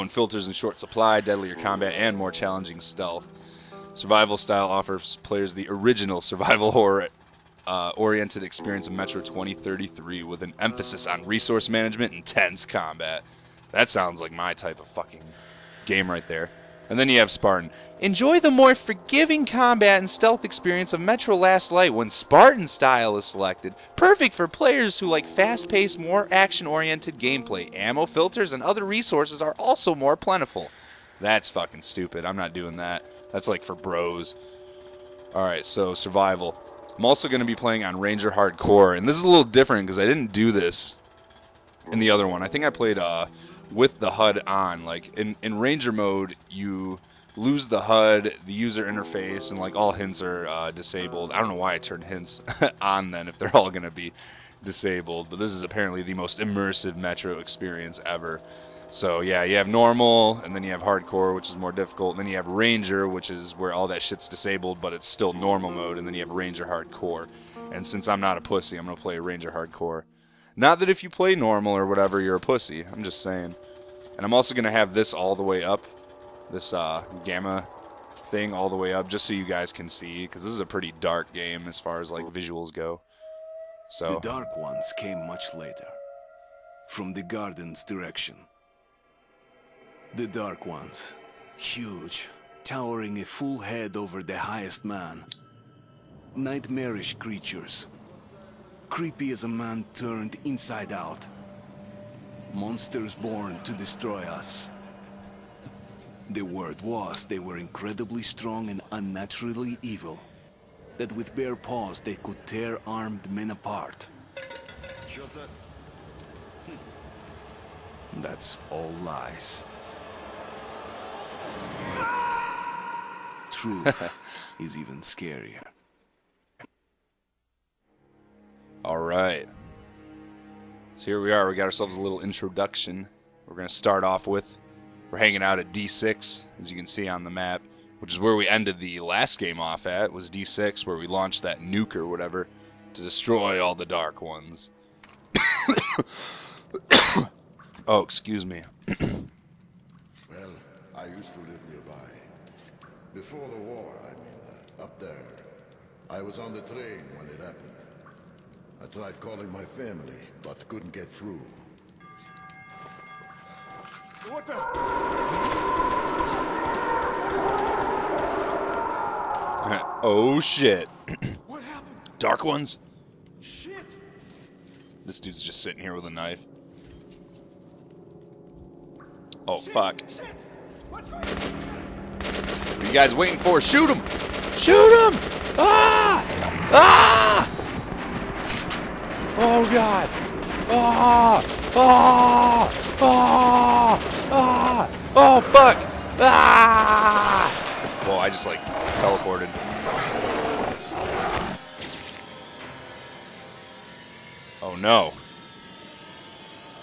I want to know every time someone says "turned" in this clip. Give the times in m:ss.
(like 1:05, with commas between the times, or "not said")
0:51, 1:39.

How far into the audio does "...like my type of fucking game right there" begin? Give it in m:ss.
0:14.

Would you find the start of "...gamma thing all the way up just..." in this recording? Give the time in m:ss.
1:17.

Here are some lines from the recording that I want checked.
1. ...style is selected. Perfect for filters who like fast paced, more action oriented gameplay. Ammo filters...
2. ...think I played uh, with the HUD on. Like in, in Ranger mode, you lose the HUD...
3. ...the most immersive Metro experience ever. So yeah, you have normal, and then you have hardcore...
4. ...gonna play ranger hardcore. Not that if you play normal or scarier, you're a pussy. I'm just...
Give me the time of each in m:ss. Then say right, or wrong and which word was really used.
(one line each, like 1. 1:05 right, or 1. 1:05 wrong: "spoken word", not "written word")
1. 0:22 wrong: "players", not "filters"
2. 0:42 right
3. 0:56 right
4. 1:08 wrong: "whatever", not "scarier".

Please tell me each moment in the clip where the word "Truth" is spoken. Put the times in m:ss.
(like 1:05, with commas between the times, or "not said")
2:03.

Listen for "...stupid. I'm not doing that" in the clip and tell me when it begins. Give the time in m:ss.
0:31.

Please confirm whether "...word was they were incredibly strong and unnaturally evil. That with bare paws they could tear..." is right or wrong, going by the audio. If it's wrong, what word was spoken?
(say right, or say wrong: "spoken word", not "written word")
right.